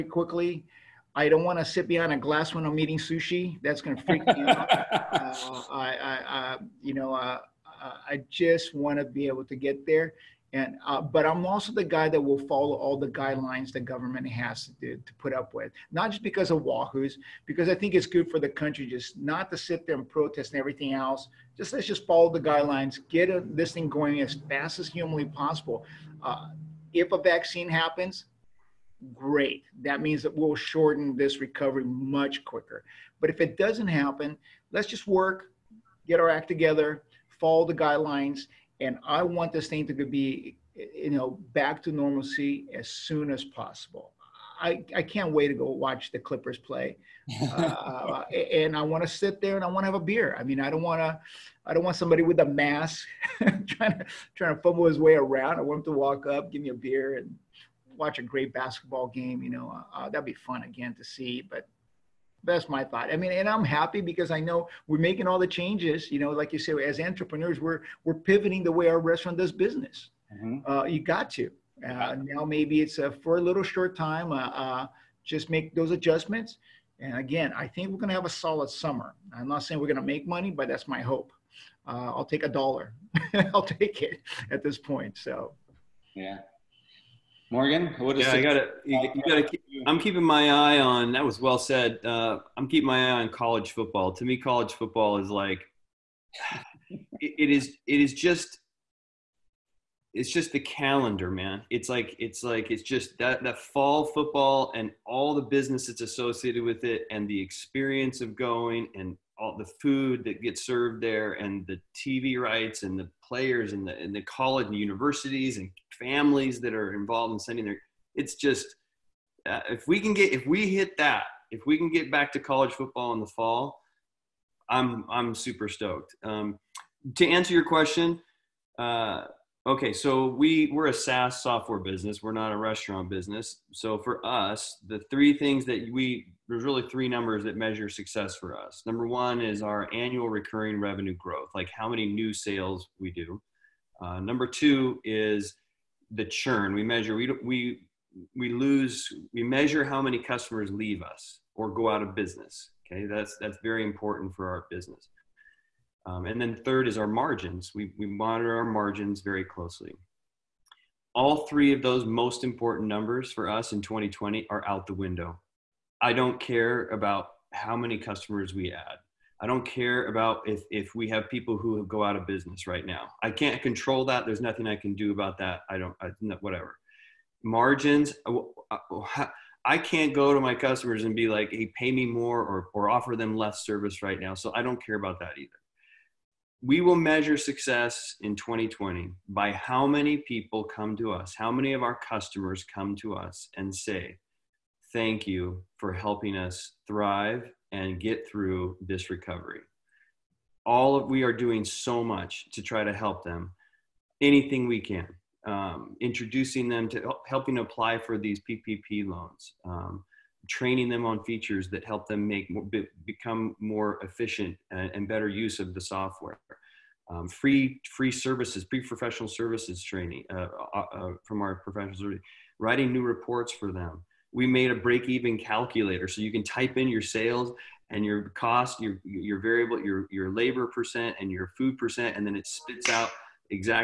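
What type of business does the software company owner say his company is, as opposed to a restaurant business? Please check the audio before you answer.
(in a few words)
SaaS software.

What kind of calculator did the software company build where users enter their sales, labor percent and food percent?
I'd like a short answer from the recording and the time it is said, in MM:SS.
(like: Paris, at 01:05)
break-even calculator, at 03:44.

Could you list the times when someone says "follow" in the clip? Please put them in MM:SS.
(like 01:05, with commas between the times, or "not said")
00:12, 00:22, 00:37.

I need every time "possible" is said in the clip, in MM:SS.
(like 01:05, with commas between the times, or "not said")
00:25, 00:43.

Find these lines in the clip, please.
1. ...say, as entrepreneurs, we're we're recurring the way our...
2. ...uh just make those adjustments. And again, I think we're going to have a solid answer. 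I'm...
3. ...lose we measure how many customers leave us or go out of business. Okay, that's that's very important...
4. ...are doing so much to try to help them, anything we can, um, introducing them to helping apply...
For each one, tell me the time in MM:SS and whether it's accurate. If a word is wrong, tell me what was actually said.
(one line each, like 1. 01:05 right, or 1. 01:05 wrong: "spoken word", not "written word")
1. 01:06 wrong: "pivoting", not "recurring"
2. 01:14 wrong: "summer", not "answer"
3. 02:28 right
4. 03:21 right.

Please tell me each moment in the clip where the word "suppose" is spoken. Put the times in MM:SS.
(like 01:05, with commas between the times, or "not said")
not said.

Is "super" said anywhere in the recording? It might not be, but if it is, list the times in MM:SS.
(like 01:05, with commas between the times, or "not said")
02:05.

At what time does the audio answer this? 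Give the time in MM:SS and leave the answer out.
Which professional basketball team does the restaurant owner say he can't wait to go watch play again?
00:46.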